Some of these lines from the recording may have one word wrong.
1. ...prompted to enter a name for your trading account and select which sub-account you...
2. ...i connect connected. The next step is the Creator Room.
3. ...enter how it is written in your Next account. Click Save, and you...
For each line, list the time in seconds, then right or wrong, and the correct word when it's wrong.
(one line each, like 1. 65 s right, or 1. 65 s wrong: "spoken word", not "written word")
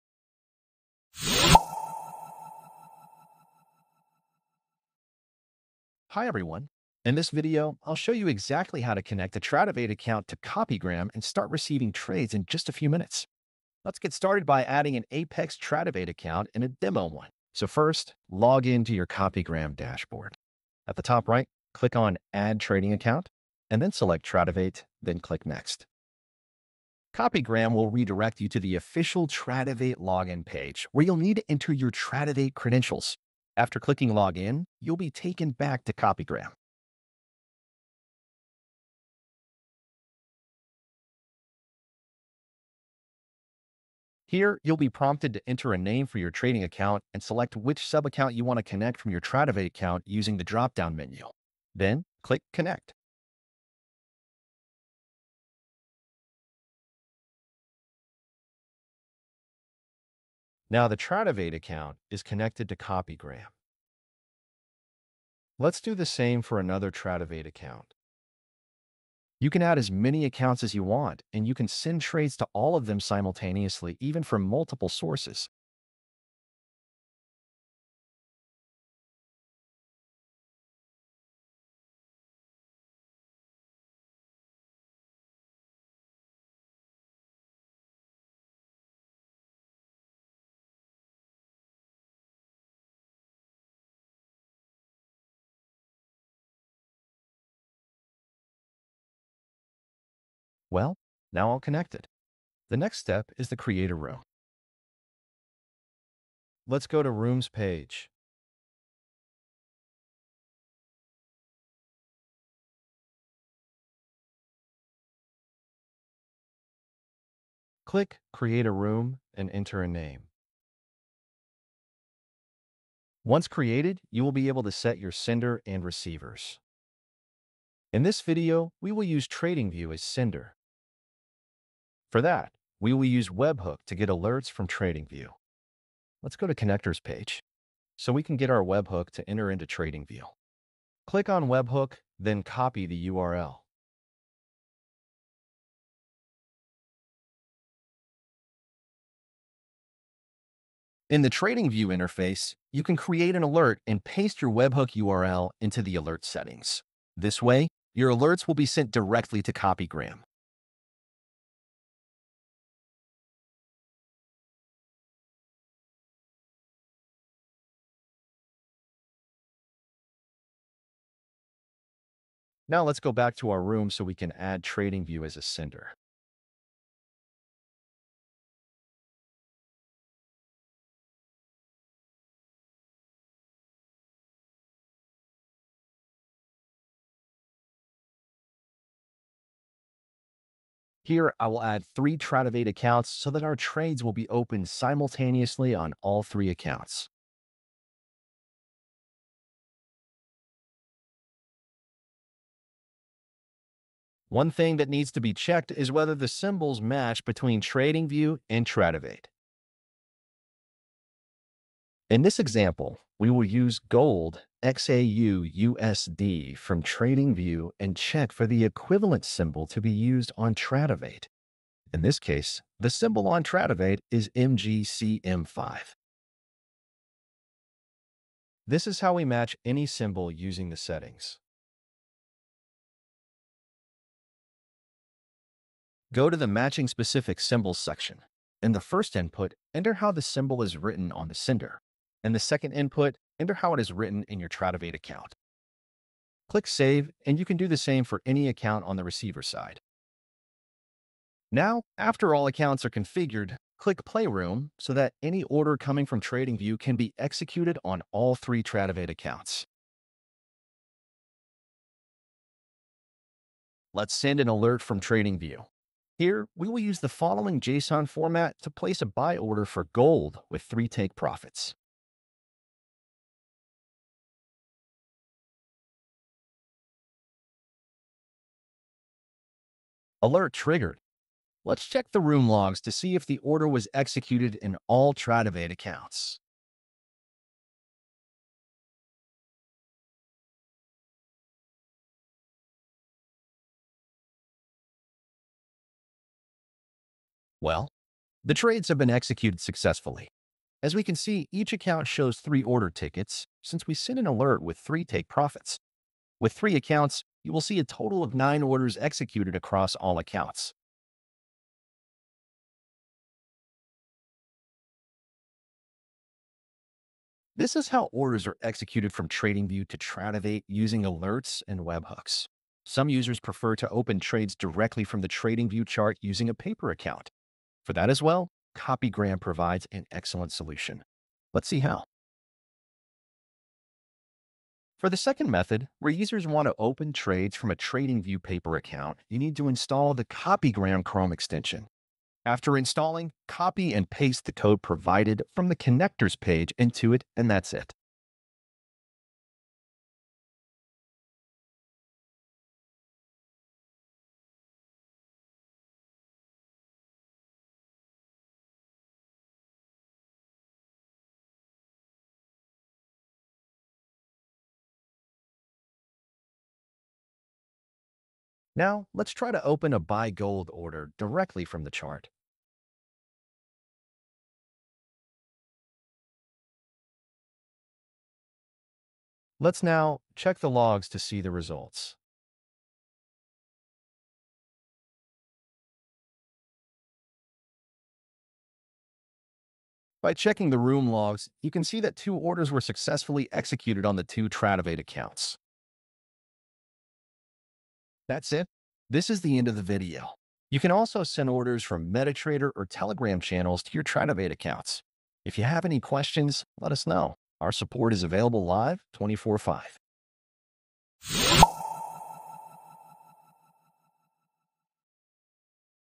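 1. 44 s right
2. 101 s right
3. 243 s wrong: "Tradovate", not "Next".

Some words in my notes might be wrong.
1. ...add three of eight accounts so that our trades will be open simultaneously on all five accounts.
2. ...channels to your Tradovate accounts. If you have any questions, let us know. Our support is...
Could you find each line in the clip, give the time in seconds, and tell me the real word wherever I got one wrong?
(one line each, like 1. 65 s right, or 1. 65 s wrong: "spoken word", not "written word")
1. 191 s wrong: "three", not "five"
2. 403 s right.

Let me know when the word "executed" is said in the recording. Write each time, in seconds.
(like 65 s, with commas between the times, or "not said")
257 s, 283 s, 299 s, 308 s, 318 s, 393 s.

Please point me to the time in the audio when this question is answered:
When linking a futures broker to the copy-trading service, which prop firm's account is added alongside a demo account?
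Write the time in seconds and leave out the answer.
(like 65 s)
15 s.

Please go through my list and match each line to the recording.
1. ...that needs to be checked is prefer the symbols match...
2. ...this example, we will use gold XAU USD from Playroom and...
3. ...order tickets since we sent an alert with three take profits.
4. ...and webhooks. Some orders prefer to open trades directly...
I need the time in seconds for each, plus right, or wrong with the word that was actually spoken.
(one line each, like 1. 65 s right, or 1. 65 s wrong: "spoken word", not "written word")
1. 204 s wrong: "whether", not "prefer"
2. 212 s wrong: "TradingView", not "Playroom"
3. 302 s right
4. 321 s wrong: "users", not "orders".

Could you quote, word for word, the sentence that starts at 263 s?
Let's send an alert from TradingView.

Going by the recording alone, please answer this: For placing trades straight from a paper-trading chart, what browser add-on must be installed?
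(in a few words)
CopyGram Chrome extension.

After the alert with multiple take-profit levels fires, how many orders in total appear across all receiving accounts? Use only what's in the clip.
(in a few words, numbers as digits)
9.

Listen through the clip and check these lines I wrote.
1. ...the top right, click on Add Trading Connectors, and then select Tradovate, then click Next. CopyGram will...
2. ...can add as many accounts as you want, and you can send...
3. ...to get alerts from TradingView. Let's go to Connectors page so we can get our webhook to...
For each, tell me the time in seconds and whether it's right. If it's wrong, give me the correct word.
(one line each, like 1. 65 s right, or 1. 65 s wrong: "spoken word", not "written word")
1. 20 s wrong: "Account", not "Connectors"
2. 69 s right
3. 133 s right.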